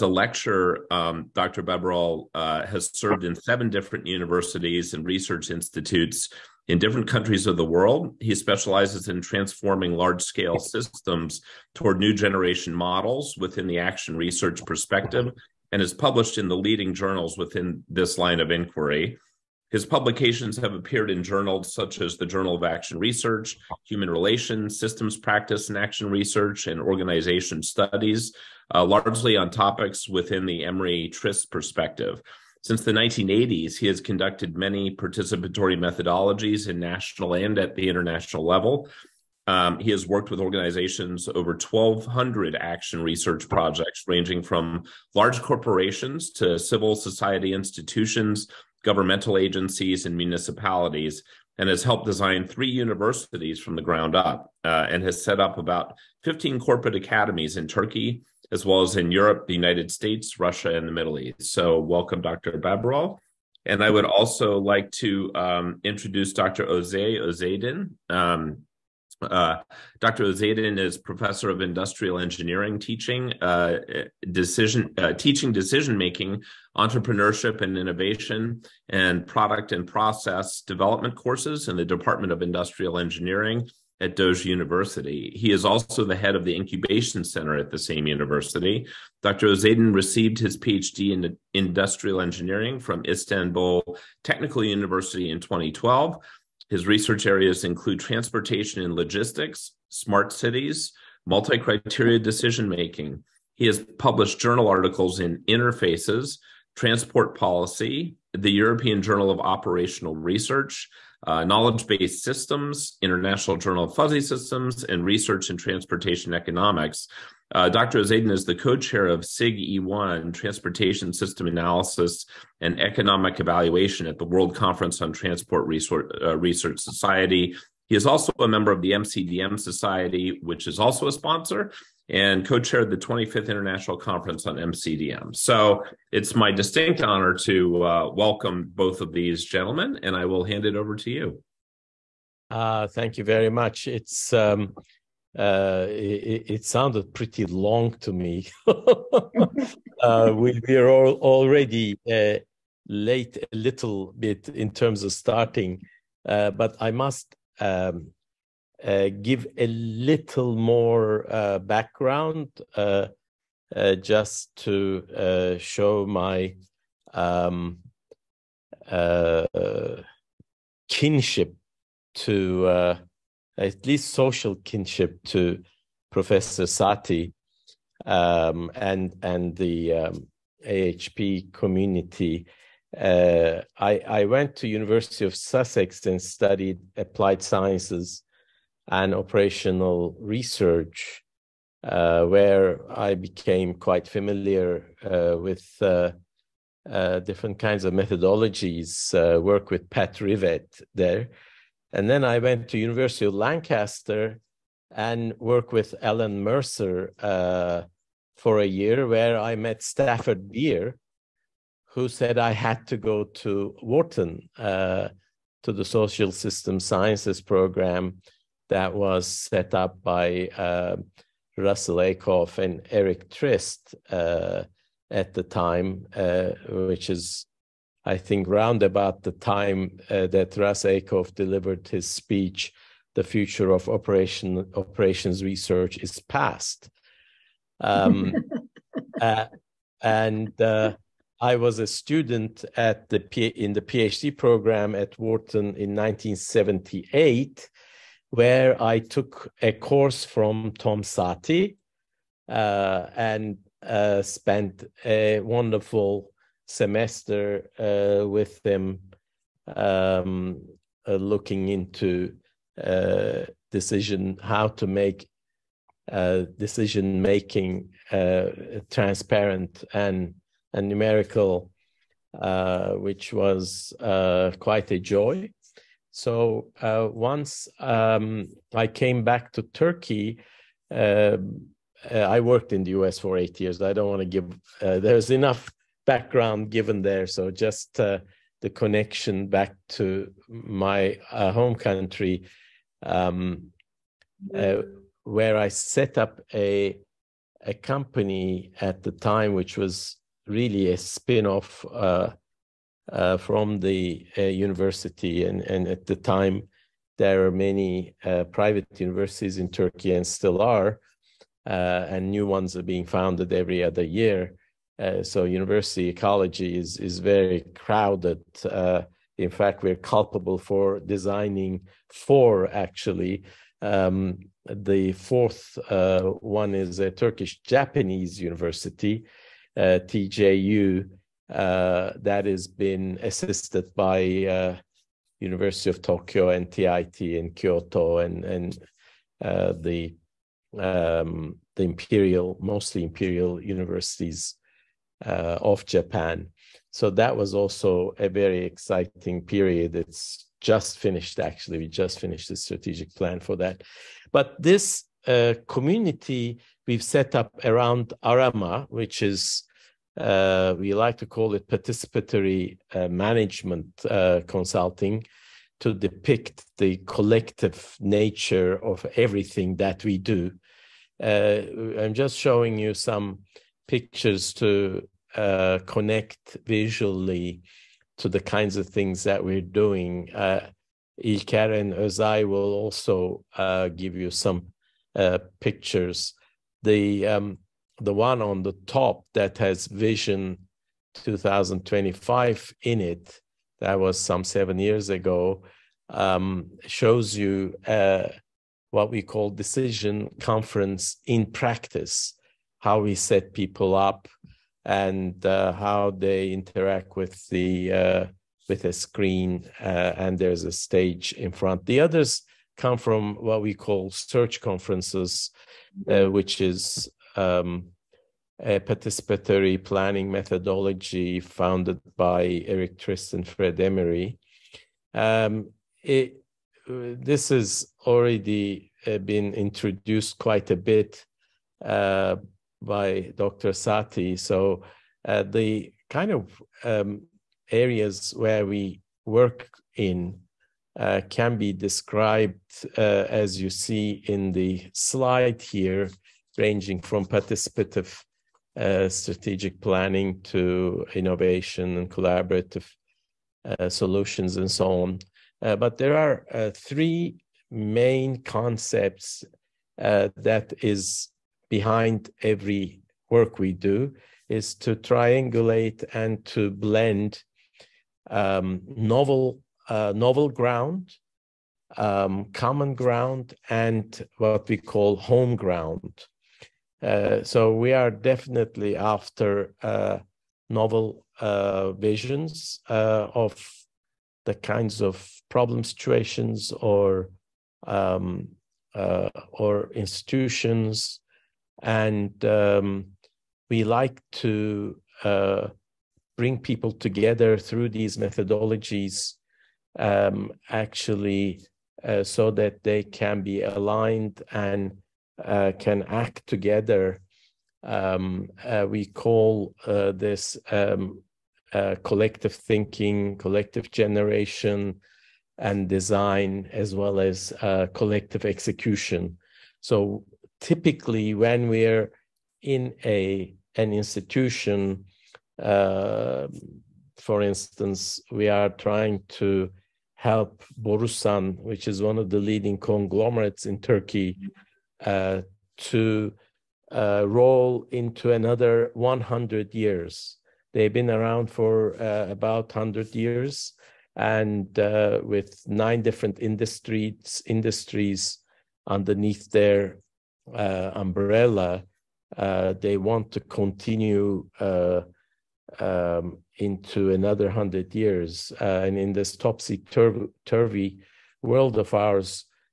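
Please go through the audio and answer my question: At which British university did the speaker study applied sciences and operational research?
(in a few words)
University of Sussex.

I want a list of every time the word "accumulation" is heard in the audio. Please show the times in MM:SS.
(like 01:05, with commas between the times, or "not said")
not said.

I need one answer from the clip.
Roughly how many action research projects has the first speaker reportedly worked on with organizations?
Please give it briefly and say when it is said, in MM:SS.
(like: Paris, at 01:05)
1,200, at 00:41.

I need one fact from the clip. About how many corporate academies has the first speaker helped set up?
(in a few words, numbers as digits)
15.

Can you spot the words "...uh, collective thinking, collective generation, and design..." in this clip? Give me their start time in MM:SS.
08:31.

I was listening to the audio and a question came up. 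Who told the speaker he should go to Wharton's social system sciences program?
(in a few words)
Stafford Beer.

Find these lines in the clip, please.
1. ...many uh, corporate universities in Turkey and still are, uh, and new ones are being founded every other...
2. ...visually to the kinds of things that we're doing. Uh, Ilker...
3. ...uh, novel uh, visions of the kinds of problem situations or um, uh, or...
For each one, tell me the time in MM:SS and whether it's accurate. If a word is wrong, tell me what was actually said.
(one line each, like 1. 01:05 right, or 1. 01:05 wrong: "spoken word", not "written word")
1. 05:07 wrong: "private", not "corporate"
2. 06:16 right
3. 07:59 right.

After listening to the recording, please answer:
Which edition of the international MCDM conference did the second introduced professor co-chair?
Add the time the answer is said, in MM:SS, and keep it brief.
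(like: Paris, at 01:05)
25th, at 02:12.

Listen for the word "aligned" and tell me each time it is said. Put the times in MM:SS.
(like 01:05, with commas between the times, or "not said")
08:23.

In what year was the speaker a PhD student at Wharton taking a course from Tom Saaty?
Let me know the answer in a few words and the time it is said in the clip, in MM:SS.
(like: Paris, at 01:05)
1978, at 04:05.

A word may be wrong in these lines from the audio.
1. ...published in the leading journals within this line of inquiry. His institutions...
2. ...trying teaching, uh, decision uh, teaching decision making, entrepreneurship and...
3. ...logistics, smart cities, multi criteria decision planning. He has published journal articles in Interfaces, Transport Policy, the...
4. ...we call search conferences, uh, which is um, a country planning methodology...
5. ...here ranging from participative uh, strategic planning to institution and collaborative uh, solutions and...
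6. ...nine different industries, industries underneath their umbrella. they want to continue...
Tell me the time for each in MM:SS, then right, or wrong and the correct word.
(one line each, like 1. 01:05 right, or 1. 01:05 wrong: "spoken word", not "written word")
1. 00:15 wrong: "publications", not "institutions"
2. 01:12 wrong: "engineering", not "trying"
3. 01:38 wrong: "making", not "planning"
4. 06:53 wrong: "participatory", not "country"
5. 07:25 wrong: "innovation", not "institution"
6. 09:05 right.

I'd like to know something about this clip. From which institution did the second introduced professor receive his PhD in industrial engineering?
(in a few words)
Istanbul Technical University.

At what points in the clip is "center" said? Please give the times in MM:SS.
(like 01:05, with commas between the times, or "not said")
01:27.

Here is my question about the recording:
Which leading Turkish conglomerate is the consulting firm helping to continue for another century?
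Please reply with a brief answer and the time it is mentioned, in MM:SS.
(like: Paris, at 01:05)
Borusan, at 08:50.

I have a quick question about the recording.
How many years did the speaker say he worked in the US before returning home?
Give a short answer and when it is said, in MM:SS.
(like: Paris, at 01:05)
8, at 04:43.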